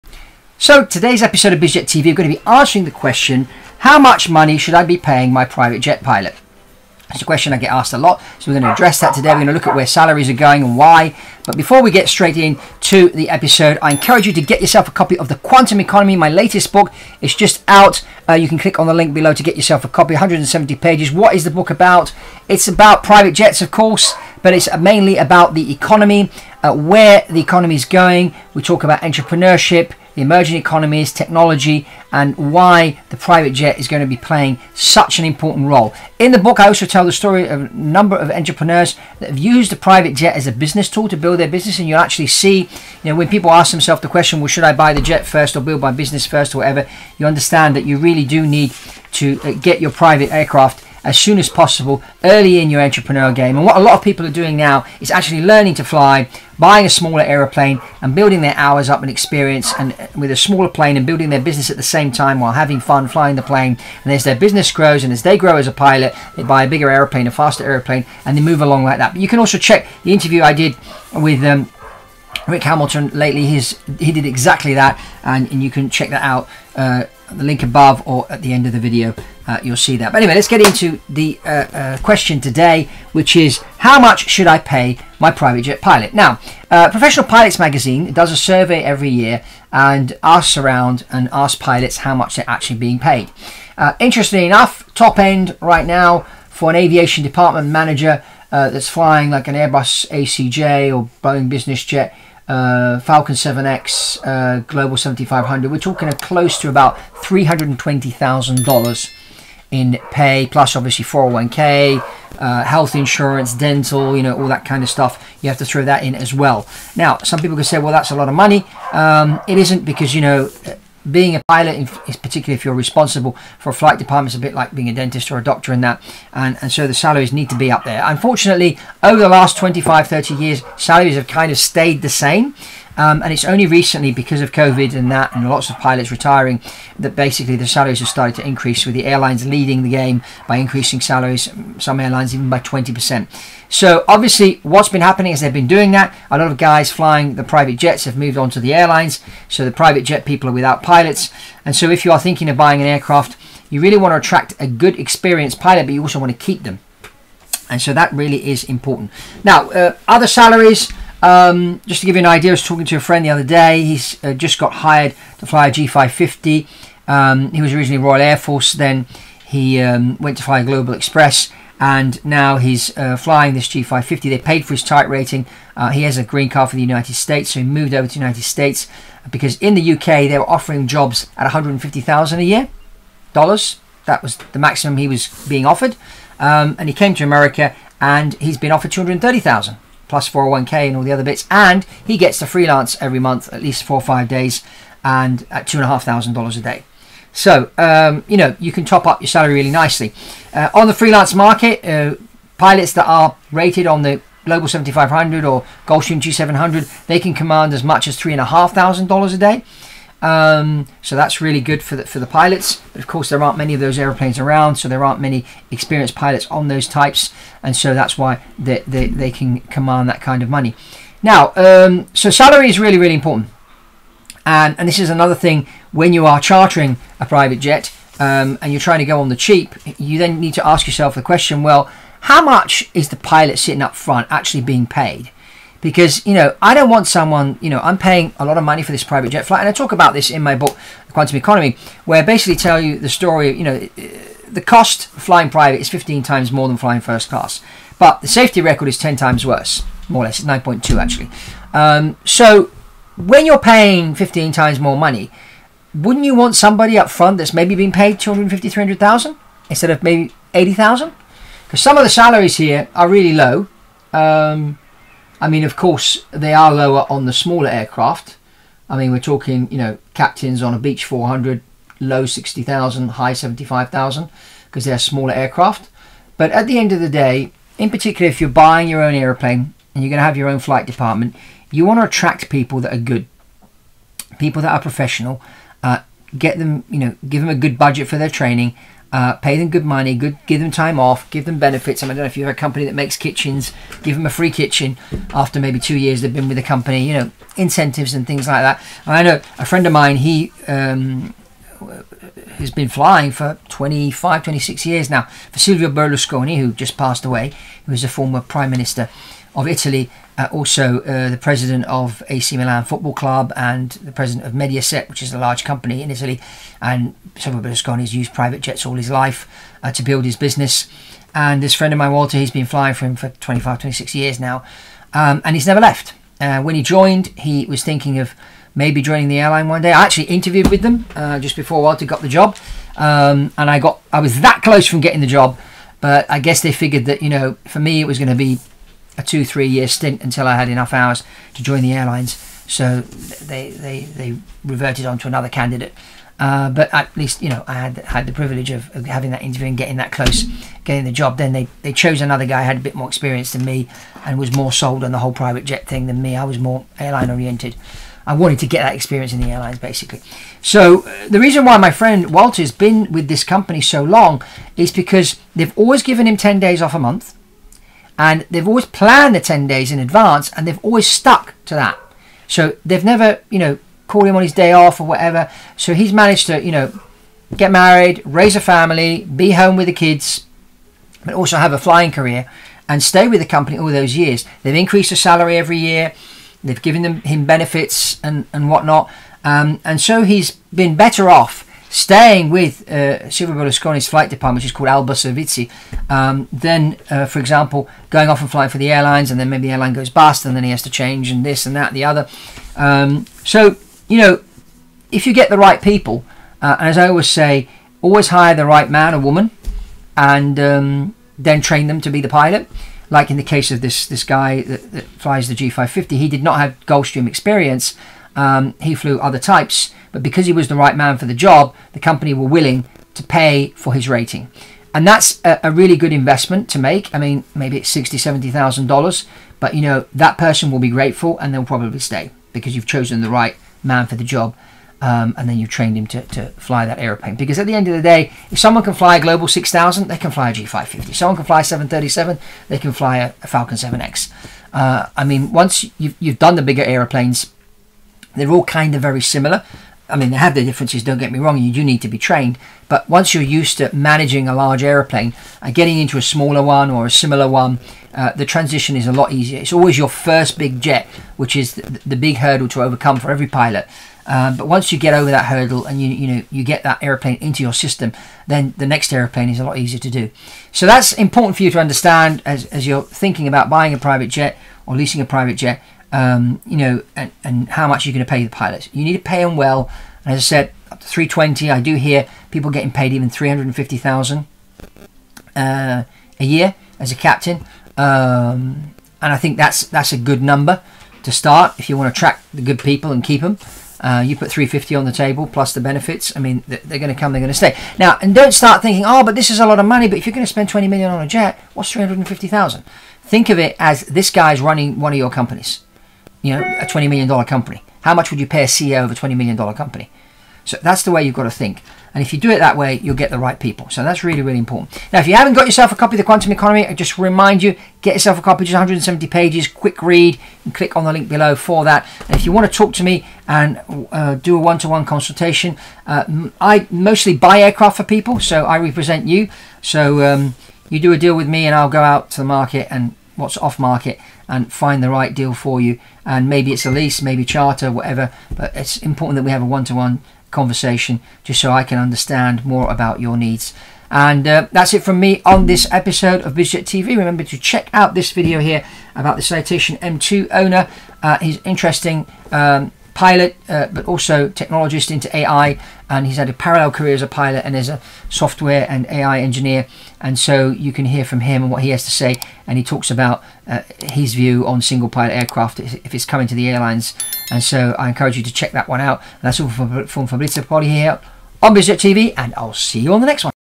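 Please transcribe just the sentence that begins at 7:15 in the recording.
Um, and then you have trained him to, to fly that aeroplane.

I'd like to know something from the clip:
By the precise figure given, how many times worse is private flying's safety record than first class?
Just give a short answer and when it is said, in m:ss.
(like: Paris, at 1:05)
9.2, at 4:10.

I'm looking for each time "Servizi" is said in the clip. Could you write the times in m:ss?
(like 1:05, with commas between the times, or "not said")
6:35.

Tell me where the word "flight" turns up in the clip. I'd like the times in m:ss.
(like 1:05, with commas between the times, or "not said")
2:03, 3:59, 4:40, 6:34.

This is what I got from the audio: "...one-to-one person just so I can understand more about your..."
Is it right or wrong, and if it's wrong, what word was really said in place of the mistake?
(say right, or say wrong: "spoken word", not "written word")
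wrong: "conversation", not "person".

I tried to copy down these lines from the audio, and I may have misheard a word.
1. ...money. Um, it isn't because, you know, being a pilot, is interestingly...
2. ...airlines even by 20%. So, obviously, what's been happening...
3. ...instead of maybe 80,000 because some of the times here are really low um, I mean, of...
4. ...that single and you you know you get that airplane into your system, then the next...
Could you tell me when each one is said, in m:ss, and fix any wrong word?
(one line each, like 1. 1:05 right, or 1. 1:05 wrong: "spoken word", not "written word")
1. 1:58 wrong: "particularly", not "interestingly"
2. 2:21 right
3. 4:19 wrong: "salaries", not "times"
4. 7:45 wrong: "hurdle", not "single".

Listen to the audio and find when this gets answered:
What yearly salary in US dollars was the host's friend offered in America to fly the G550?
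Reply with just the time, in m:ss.
3:08.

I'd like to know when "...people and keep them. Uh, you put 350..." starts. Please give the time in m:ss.
8:12.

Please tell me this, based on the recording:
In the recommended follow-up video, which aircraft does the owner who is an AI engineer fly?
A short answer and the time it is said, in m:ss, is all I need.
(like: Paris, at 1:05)
Citation M2, at 9:09.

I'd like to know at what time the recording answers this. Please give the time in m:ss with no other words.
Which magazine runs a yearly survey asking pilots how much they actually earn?
1:26.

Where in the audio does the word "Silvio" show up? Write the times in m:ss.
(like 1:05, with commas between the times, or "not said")
5:05, 5:17, 6:33.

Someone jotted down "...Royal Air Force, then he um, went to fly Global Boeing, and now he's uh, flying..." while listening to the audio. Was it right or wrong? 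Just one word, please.
wrong.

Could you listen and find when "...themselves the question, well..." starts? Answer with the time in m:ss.
0:43.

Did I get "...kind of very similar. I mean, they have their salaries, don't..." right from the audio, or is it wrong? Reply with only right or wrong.
wrong.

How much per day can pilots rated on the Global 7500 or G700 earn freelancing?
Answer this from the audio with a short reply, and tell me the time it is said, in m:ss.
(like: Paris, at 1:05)
$3,500, at 3:28.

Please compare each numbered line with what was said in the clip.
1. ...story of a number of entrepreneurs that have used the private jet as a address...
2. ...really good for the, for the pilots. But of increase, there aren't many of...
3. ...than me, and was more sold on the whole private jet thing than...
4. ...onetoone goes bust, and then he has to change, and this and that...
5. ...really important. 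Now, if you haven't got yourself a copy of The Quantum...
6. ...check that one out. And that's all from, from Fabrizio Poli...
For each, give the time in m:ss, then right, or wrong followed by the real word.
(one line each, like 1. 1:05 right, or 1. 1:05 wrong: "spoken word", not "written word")
1. 0:37 wrong: "business", not "address"
2. 3:31 wrong: "course", not "increase"
3. 5:53 right
4. 6:39 wrong: "airline", not "onetoone"
5. 8:34 right
6. 9:28 right.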